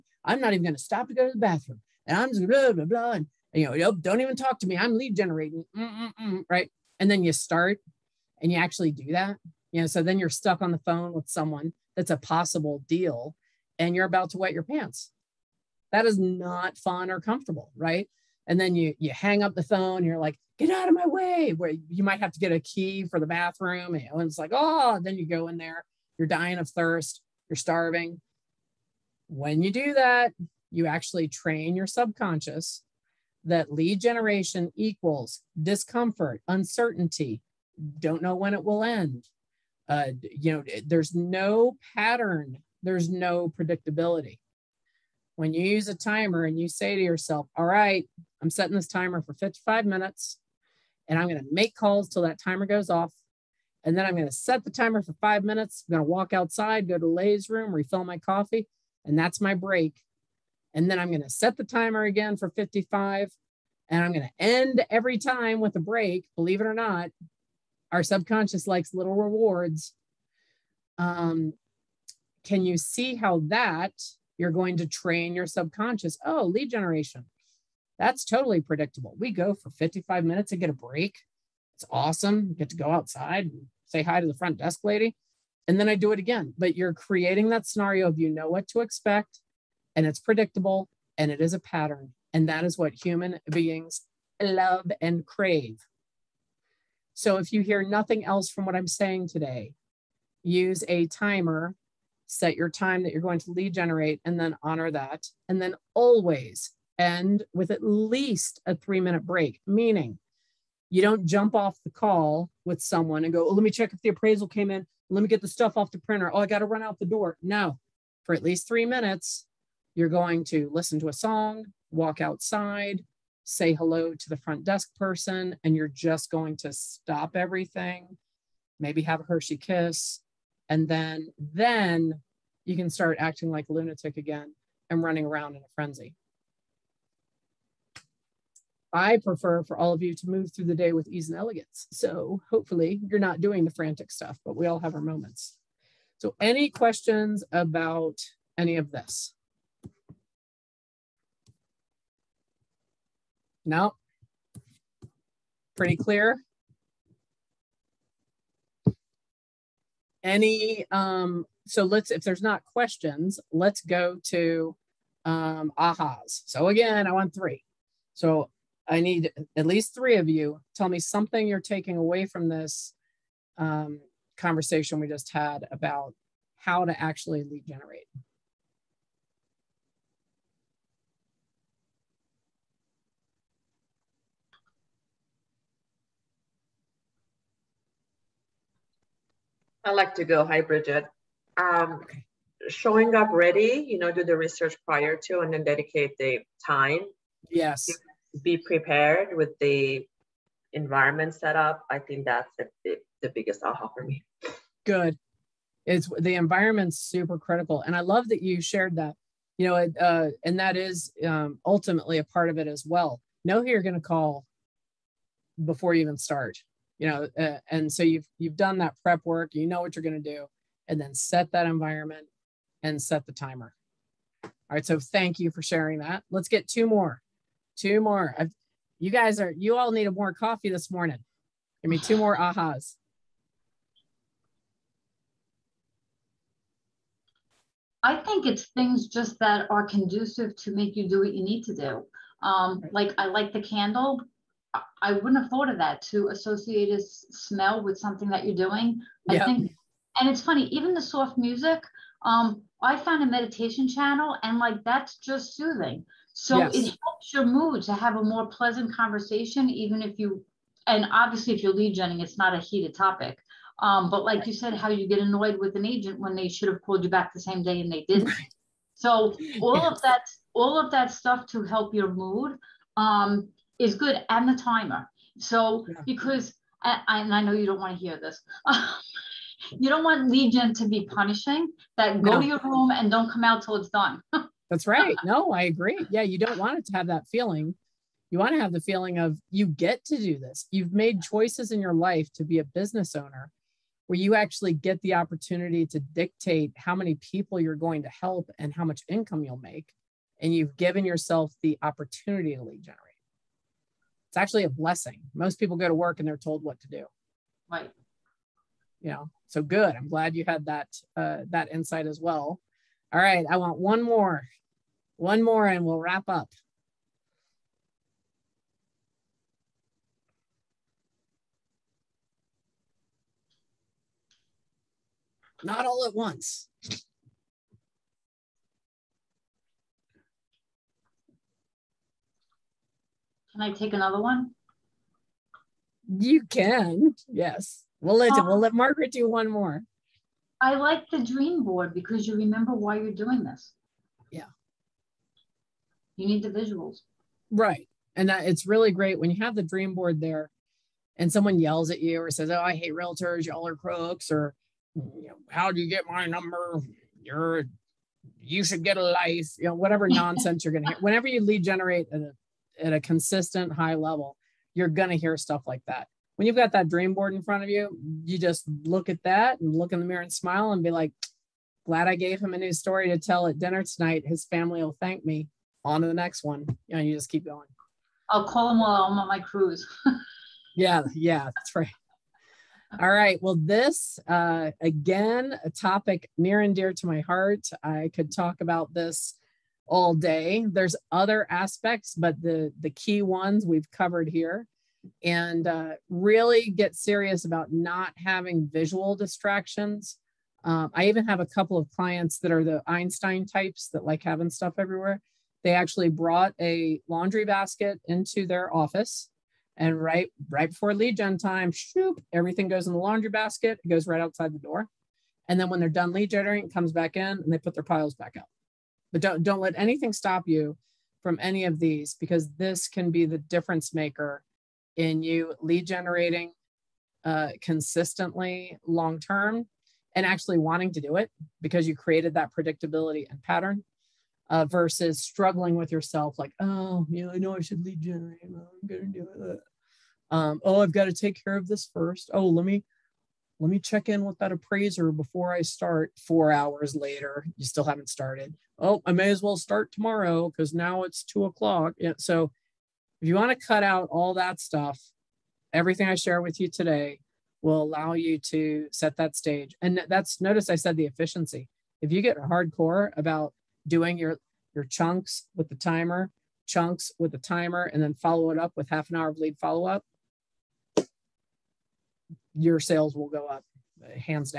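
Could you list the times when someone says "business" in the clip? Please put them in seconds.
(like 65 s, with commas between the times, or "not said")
292 s.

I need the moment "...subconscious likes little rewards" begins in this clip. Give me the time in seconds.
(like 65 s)
68 s.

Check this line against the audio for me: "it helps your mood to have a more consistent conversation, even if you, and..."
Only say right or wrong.
wrong.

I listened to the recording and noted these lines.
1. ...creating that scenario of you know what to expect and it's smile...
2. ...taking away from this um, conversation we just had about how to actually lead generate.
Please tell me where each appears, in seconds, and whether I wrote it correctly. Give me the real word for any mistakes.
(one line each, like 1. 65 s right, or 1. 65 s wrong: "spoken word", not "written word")
1. 86 s wrong: "predictable", not "smile"
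2. 171 s right.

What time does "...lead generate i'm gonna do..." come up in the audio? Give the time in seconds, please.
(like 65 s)
437 s.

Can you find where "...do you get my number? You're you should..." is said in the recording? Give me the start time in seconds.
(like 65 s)
355 s.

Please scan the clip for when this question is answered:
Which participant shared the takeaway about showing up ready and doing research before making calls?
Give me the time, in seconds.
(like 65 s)
190 s.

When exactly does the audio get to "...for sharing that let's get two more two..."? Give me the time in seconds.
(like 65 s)
225 s.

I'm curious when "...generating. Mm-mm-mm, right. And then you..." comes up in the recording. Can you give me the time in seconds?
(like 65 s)
5 s.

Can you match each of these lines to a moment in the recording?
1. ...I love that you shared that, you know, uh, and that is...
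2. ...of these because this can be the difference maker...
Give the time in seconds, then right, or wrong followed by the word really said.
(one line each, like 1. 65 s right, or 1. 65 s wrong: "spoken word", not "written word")
1. 207 s right
2. 421 s right.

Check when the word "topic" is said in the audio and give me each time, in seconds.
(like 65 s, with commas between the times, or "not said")
262 s, 385 s.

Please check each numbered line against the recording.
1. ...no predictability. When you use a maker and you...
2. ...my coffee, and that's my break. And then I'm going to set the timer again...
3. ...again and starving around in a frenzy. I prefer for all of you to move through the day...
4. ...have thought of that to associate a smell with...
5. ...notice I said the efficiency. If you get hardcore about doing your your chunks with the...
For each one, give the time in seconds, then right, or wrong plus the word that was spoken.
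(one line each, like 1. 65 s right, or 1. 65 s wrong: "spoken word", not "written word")
1. 43 s wrong: "timer", not "maker"
2. 58 s right
3. 134 s wrong: "running", not "starving"
4. 245 s right
5. 460 s right.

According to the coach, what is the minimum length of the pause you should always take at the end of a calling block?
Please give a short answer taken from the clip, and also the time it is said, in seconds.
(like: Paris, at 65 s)
3 minutes, at 108 s.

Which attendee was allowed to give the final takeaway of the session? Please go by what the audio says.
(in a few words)
Margaret.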